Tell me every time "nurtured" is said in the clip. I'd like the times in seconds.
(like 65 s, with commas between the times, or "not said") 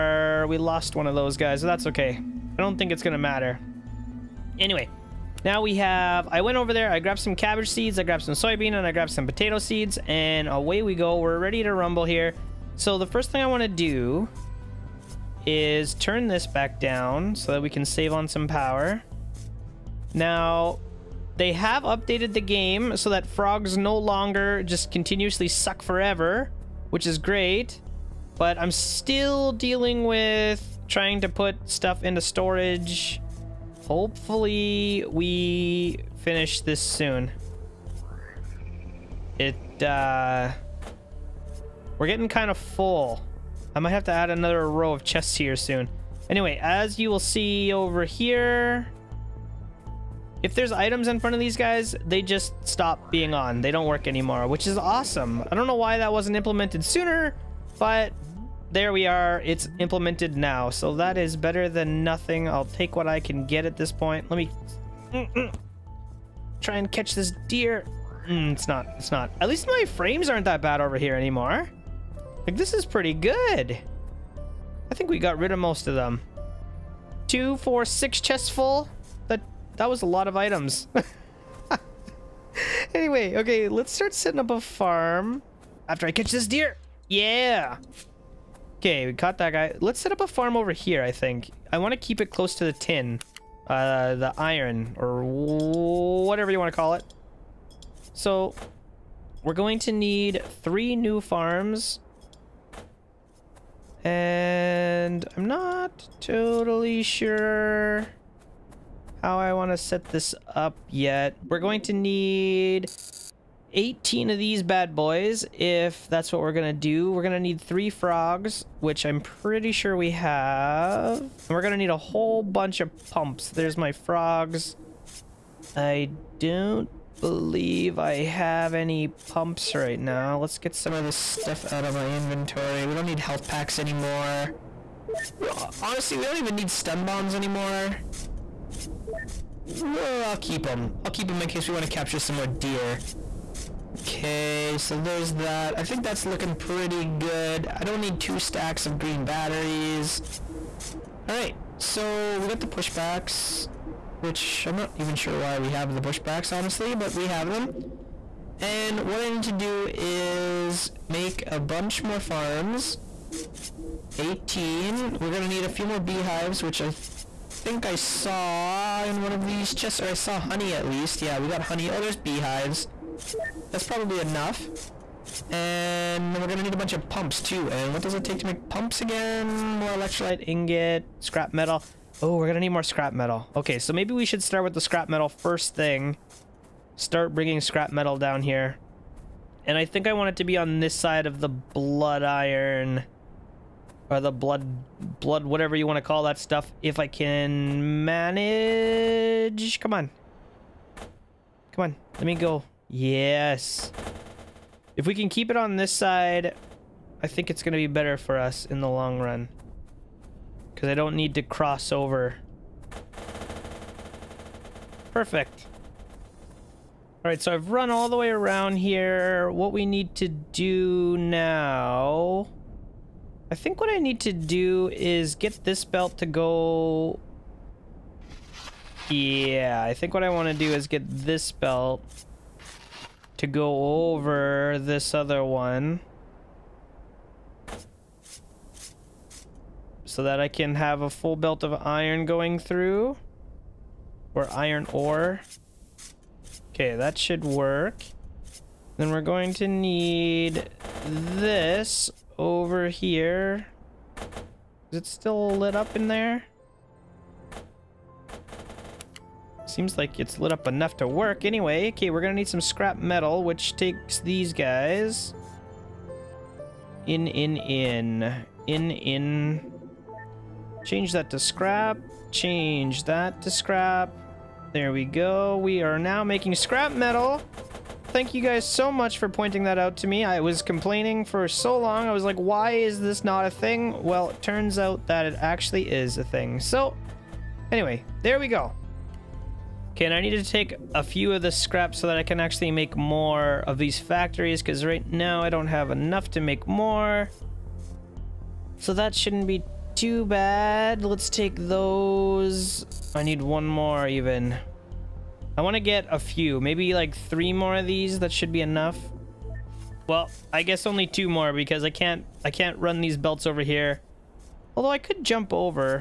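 not said.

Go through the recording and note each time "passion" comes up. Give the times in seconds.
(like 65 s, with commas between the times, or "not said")
not said.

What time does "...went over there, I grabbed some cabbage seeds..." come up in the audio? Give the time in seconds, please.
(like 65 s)
6 s.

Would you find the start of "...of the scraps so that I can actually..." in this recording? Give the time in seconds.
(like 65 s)
291 s.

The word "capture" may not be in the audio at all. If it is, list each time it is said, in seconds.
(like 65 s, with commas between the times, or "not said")
141 s.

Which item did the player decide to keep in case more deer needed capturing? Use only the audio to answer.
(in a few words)
stun bombs.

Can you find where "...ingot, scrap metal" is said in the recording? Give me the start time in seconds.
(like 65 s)
180 s.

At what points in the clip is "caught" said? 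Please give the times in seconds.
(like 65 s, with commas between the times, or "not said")
89 s.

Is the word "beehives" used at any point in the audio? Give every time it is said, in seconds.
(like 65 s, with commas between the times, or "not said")
165 s, 172 s.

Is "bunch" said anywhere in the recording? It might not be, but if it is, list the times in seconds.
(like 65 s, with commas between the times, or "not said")
122 s, 161 s, 176 s.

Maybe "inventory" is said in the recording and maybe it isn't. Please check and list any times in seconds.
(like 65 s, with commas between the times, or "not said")
132 s.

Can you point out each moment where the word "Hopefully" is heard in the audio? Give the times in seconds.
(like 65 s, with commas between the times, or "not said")
33 s.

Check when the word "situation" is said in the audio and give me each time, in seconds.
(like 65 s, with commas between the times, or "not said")
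not said.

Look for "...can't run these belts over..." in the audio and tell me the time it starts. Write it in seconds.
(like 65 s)
312 s.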